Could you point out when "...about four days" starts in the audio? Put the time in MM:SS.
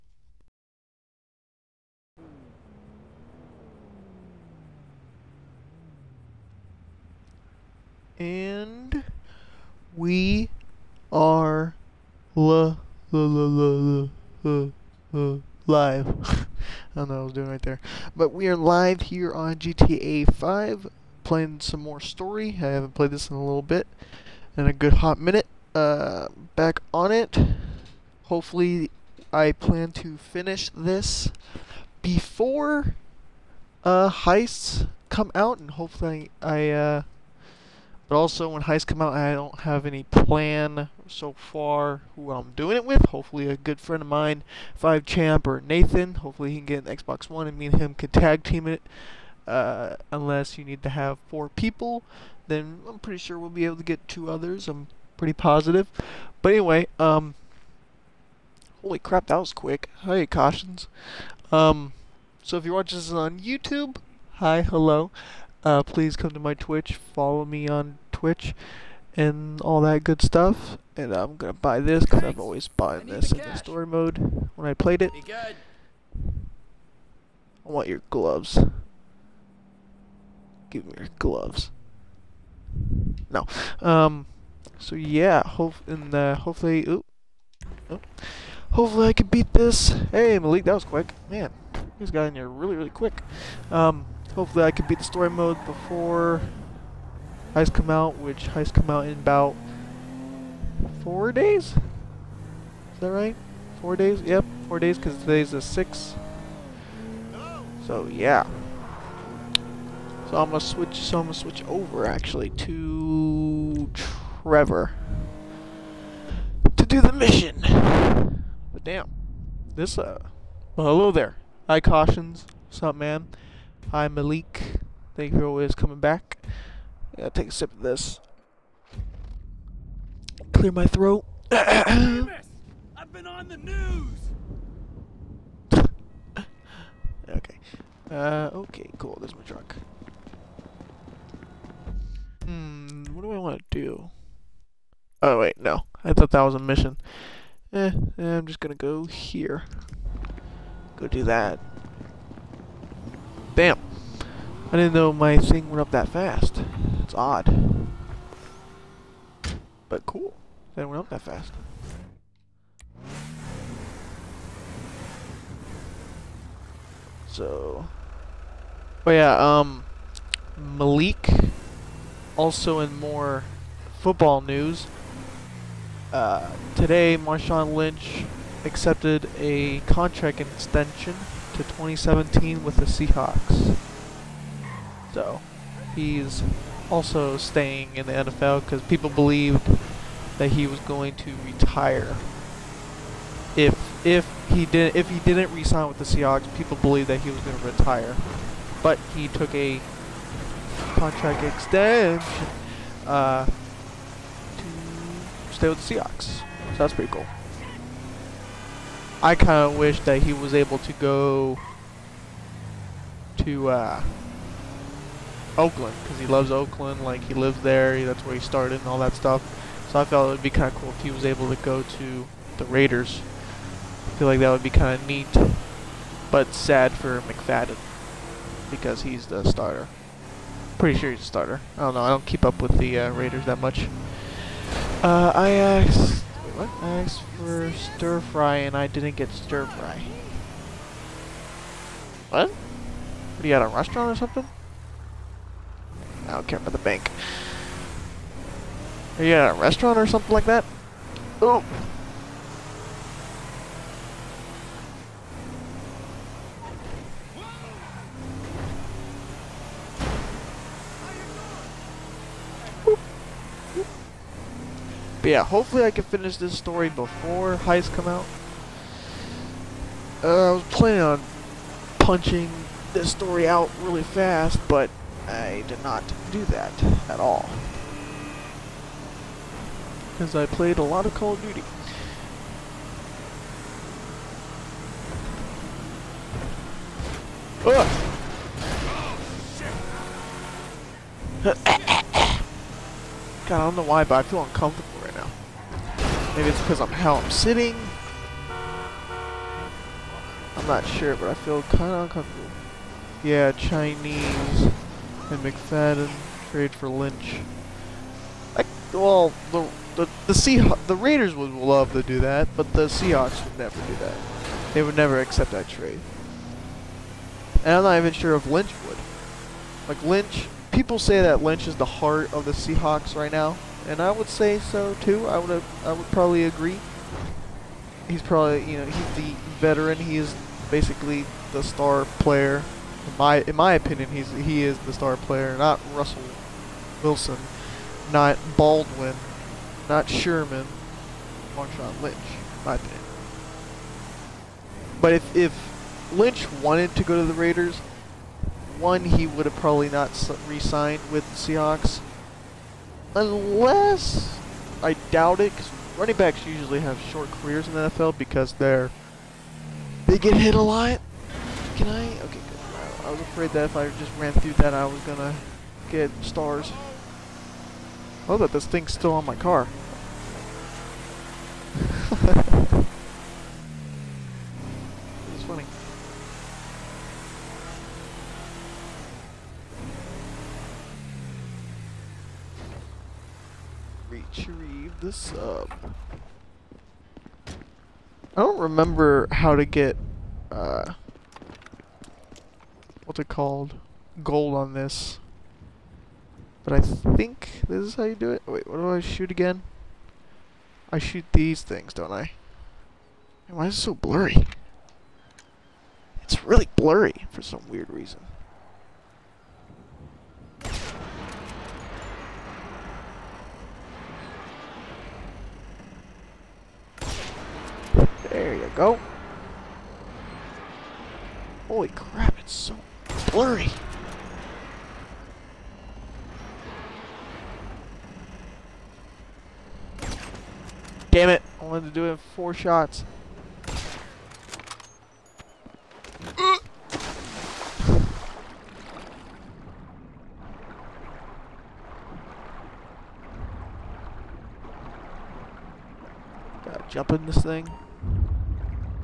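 01:39.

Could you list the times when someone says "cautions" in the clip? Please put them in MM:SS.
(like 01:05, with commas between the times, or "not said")
01:00, 02:01.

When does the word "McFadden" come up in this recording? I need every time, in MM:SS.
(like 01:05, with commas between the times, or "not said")
03:47, 05:05.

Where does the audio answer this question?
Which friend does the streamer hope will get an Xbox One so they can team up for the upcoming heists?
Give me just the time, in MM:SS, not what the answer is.
00:45.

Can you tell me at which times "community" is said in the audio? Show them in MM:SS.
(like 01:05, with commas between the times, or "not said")
not said.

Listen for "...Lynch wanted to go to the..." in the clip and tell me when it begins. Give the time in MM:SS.
05:46.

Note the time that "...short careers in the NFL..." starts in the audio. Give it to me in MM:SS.
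05:57.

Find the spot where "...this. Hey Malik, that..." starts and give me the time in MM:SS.
01:29.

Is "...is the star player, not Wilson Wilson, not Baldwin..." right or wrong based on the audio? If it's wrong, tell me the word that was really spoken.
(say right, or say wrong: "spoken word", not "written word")
wrong: "Russell", not "Wilson".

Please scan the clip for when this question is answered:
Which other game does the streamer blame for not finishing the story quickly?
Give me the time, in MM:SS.
04:41.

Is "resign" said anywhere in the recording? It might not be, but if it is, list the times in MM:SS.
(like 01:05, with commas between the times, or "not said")
03:15.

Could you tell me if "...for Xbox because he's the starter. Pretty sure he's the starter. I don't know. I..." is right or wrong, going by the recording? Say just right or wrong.
wrong.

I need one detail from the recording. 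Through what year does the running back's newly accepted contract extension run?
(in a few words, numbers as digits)
2017.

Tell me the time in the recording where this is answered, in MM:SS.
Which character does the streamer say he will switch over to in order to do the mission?
01:53.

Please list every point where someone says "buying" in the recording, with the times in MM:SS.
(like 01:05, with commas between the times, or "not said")
01:12.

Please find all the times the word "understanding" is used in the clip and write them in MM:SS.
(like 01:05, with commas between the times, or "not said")
not said.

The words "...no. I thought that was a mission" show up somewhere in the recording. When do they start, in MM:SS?
02:25.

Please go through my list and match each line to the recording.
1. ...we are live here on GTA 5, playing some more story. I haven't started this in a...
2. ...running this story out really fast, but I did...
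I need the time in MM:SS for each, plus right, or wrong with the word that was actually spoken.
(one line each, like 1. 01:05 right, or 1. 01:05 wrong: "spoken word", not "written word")
1. 00:18 wrong: "played", not "started"
2. 04:31 wrong: "punching", not "running".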